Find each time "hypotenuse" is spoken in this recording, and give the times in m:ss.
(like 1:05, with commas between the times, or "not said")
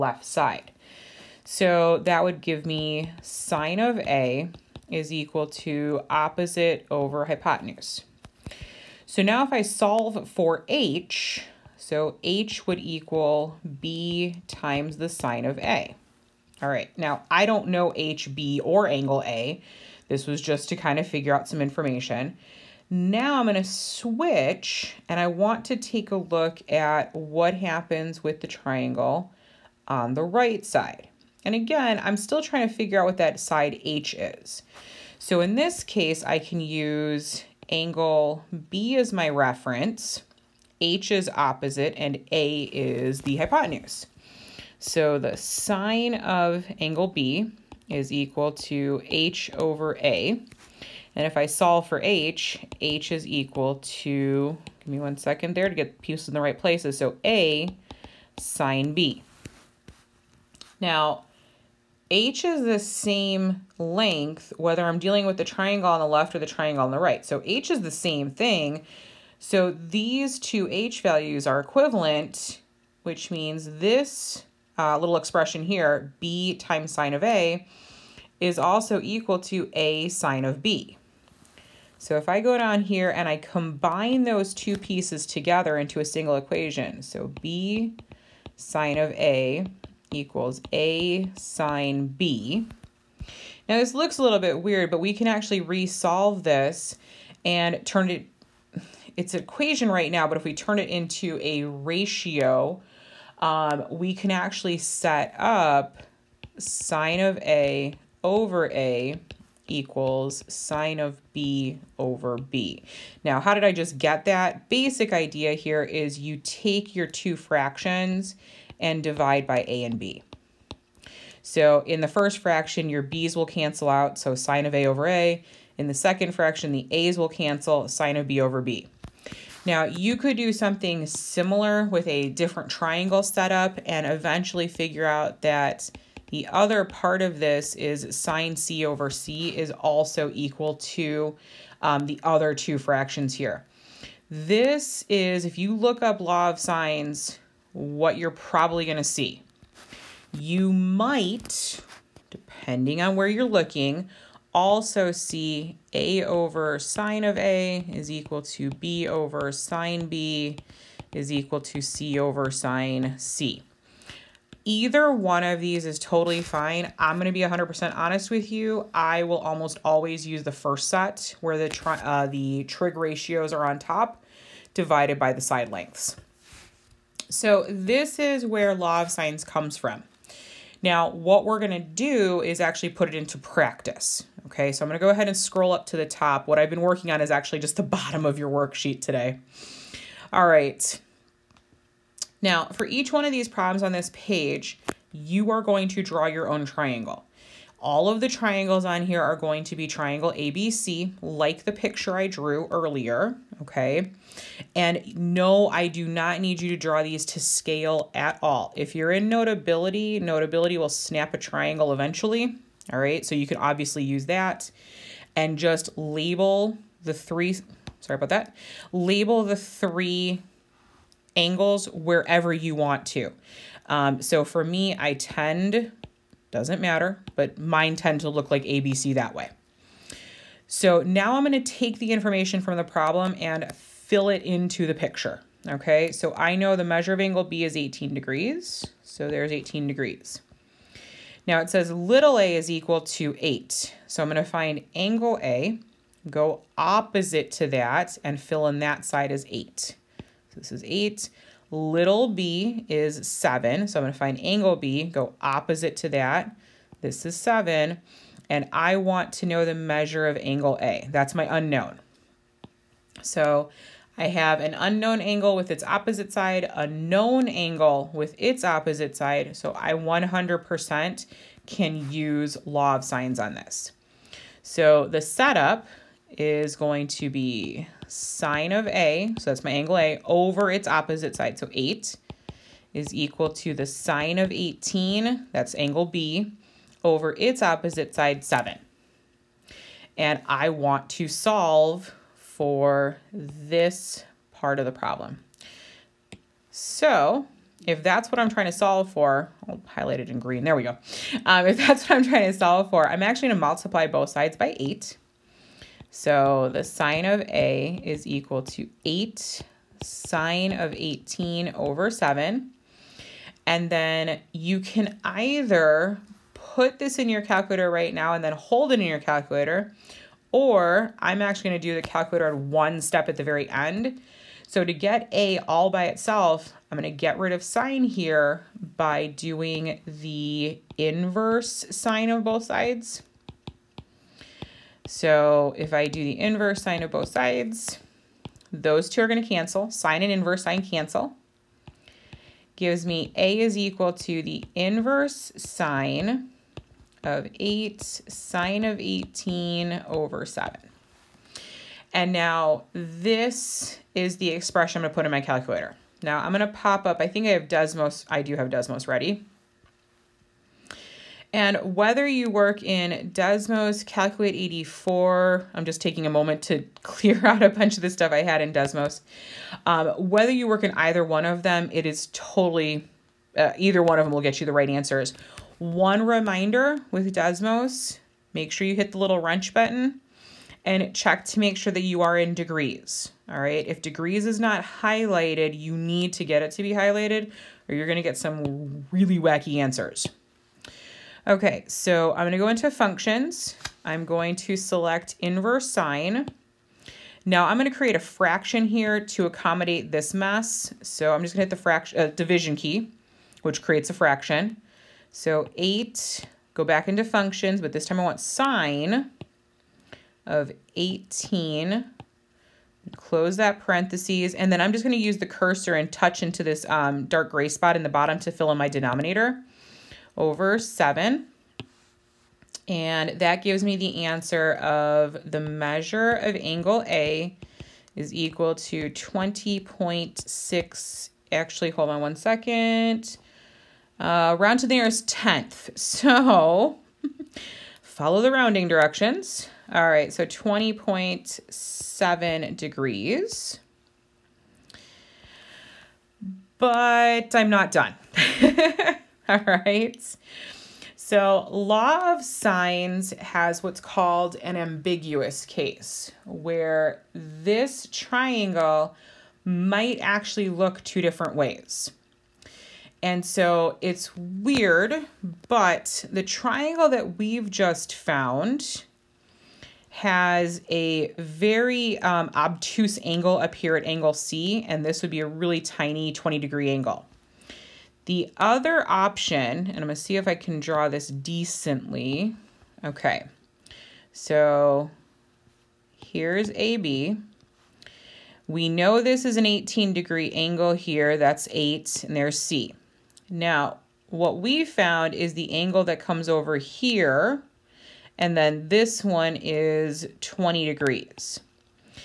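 0:07, 0:43.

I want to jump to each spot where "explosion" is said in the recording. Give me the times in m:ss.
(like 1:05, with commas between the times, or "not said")
not said.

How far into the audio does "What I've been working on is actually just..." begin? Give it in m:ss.
3:06.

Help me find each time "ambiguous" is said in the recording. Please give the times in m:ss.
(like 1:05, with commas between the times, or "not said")
7:34.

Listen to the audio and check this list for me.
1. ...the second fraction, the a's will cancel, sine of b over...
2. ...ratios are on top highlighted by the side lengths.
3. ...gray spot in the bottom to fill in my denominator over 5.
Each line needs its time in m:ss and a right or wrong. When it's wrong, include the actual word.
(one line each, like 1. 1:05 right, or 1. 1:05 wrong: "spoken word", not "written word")
1. 2:05 right
2. 2:52 wrong: "divided", not "highlighted"
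3. 6:57 wrong: "7", not "5".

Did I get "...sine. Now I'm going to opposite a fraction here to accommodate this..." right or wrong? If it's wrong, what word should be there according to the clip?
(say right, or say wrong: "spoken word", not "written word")
wrong: "create", not "opposite".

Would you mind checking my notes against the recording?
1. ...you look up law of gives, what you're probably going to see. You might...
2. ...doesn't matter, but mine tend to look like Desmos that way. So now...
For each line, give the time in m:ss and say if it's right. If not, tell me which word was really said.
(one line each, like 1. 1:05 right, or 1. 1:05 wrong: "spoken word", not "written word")
1. 2:25 wrong: "sines", not "gives"
2. 3:46 wrong: "ABC", not "Desmos".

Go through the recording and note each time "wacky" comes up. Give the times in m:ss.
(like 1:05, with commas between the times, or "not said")
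6:29.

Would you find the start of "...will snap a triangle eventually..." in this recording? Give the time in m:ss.
3:30.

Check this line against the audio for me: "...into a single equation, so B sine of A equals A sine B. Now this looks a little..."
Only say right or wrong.
right.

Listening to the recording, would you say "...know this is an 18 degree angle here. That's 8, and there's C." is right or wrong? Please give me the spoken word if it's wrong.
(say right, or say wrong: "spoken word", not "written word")
right.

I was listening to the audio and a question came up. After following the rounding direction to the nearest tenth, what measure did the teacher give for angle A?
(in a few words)
20.7 degrees.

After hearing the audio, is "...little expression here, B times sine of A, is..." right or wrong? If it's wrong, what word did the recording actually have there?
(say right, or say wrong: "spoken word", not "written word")
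right.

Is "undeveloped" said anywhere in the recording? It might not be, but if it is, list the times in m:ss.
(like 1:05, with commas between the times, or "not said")
not said.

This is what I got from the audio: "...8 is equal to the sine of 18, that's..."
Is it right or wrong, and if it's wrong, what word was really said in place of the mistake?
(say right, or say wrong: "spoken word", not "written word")
right.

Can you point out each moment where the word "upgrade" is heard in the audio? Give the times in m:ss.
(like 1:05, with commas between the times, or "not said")
not said.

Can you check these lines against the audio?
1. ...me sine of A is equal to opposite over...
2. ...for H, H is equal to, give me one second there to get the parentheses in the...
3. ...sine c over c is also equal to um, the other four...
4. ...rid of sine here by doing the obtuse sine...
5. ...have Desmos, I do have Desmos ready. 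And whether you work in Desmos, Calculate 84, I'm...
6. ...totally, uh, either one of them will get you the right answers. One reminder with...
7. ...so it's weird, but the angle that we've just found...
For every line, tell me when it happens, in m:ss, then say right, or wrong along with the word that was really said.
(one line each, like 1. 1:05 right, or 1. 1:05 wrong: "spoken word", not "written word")
1. 0:02 right
2. 0:51 wrong: "pieces", not "parentheses"
3. 2:18 wrong: "two", not "four"
4. 5:27 wrong: "inverse", not "obtuse"
5. 5:57 right
6. 6:12 right
7. 7:43 wrong: "triangle", not "angle".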